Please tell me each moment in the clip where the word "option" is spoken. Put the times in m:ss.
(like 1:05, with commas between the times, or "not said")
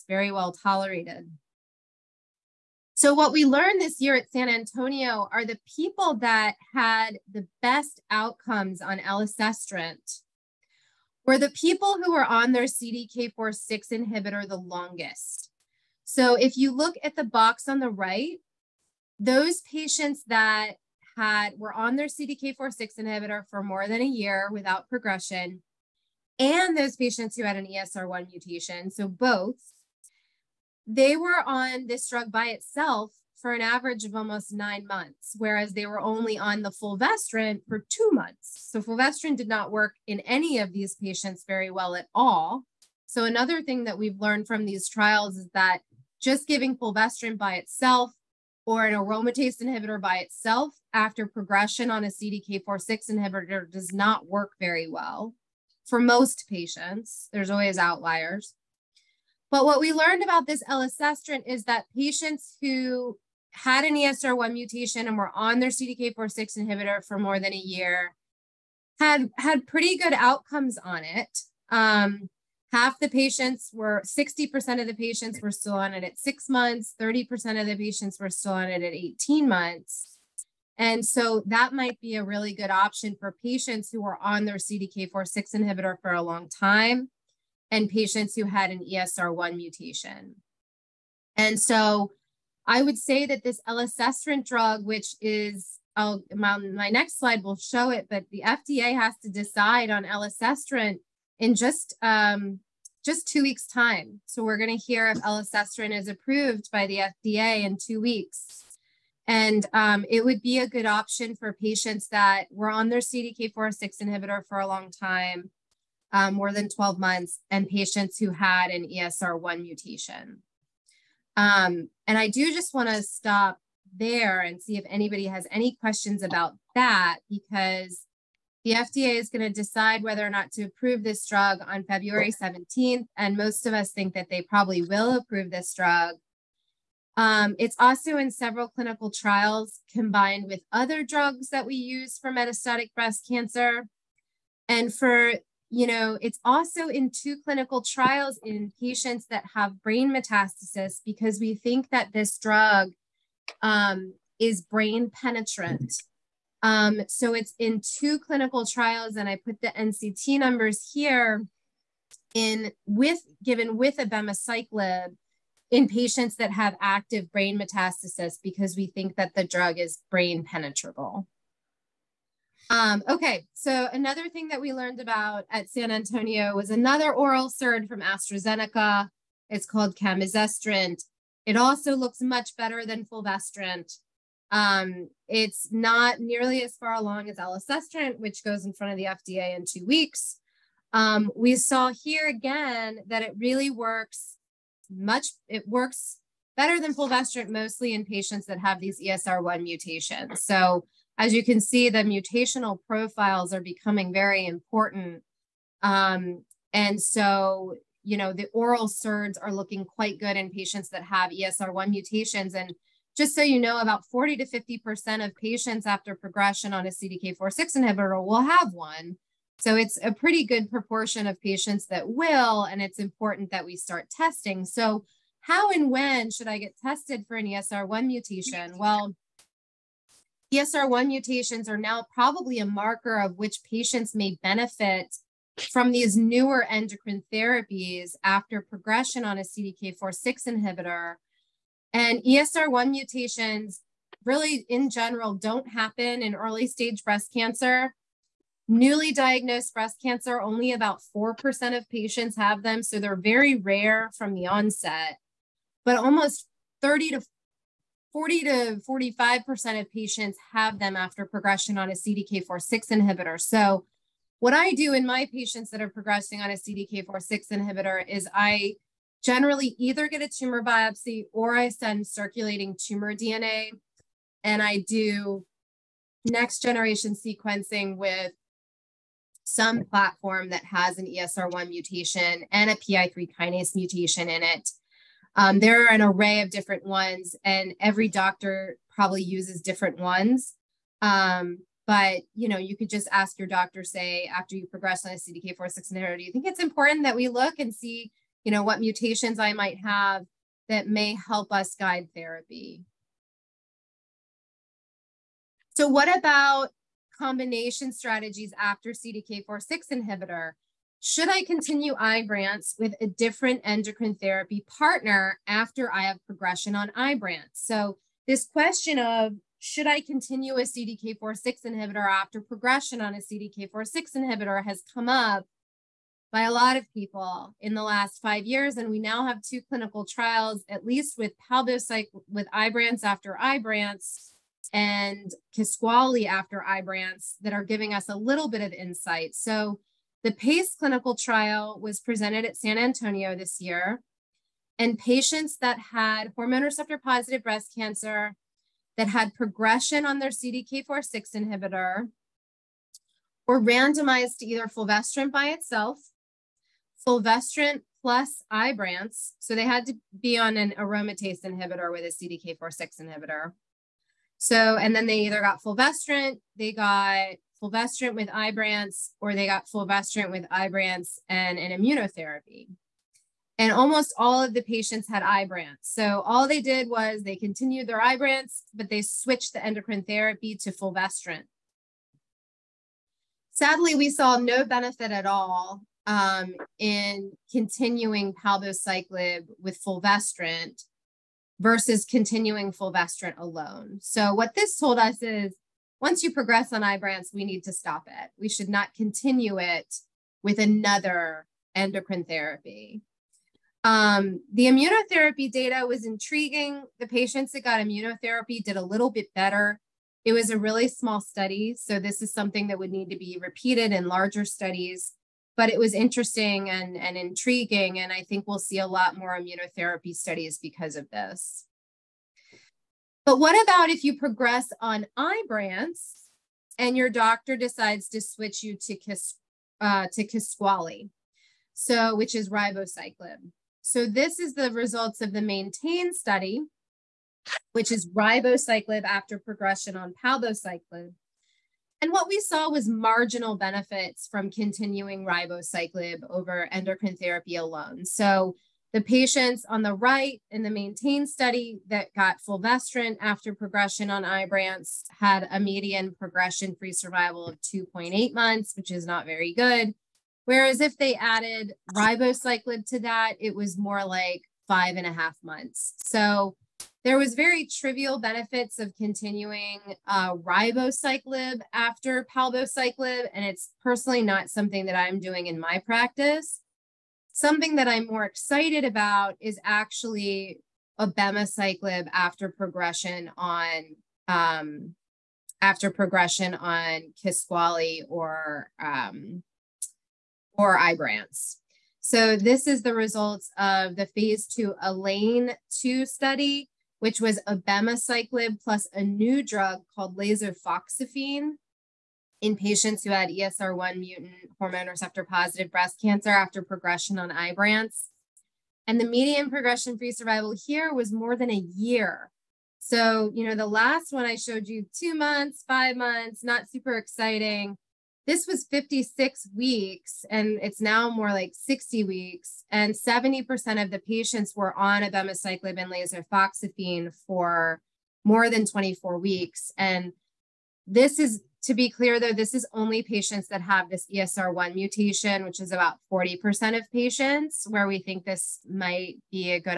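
1:22, 1:50.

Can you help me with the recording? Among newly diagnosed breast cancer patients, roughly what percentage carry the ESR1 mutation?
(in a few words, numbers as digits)
4%.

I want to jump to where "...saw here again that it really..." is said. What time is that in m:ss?
3:11.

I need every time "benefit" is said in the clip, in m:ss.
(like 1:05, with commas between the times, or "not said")
3:54, 6:24, 7:23, 7:48.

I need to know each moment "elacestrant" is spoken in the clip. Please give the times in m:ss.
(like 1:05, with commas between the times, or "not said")
0:08, 1:00, 1:33, 1:40, 1:45, 3:07.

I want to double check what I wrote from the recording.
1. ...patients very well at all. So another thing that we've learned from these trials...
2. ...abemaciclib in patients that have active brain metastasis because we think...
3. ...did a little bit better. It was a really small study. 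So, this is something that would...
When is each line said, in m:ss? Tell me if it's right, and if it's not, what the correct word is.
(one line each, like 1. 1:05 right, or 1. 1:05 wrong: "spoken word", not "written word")
1. 0:40 right
2. 2:43 right
3. 6:48 right.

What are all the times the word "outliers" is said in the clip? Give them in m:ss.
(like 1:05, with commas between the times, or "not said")
0:57.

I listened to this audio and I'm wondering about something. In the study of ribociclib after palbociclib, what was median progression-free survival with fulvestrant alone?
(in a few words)
2.8 months.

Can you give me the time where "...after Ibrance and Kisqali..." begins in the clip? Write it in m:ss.
5:33.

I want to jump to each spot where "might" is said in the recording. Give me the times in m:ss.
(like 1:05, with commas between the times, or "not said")
1:21, 4:59, 8:58.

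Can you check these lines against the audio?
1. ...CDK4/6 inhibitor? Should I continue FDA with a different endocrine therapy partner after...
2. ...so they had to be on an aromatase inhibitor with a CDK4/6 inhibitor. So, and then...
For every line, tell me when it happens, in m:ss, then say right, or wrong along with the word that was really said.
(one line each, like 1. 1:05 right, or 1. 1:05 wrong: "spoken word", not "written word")
1. 5:08 wrong: "Ibrance", not "FDA"
2. 5:59 right.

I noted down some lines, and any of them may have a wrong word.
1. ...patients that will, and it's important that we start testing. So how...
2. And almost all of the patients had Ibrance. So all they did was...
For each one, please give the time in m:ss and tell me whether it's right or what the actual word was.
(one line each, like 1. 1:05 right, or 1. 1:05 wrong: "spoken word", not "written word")
1. 3:41 right
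2. 6:13 right.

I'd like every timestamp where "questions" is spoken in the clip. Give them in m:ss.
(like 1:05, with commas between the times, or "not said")
2:05, 5:18.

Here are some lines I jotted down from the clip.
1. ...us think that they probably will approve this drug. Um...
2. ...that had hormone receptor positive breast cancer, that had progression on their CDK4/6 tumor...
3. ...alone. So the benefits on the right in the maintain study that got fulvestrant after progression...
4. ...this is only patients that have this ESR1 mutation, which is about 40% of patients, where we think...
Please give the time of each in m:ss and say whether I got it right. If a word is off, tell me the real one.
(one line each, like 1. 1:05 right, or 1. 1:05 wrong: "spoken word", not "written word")
1. 2:13 right
2. 5:45 wrong: "inhibitor", not "tumor"
3. 7:27 wrong: "patients", not "benefits"
4. 8:52 right.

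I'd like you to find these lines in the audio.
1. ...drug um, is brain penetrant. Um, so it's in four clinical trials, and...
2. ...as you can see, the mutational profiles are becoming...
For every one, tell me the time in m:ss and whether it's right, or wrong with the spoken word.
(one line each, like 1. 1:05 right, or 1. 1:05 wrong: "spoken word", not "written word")
1. 2:32 wrong: "two", not "four"
2. 3:21 right.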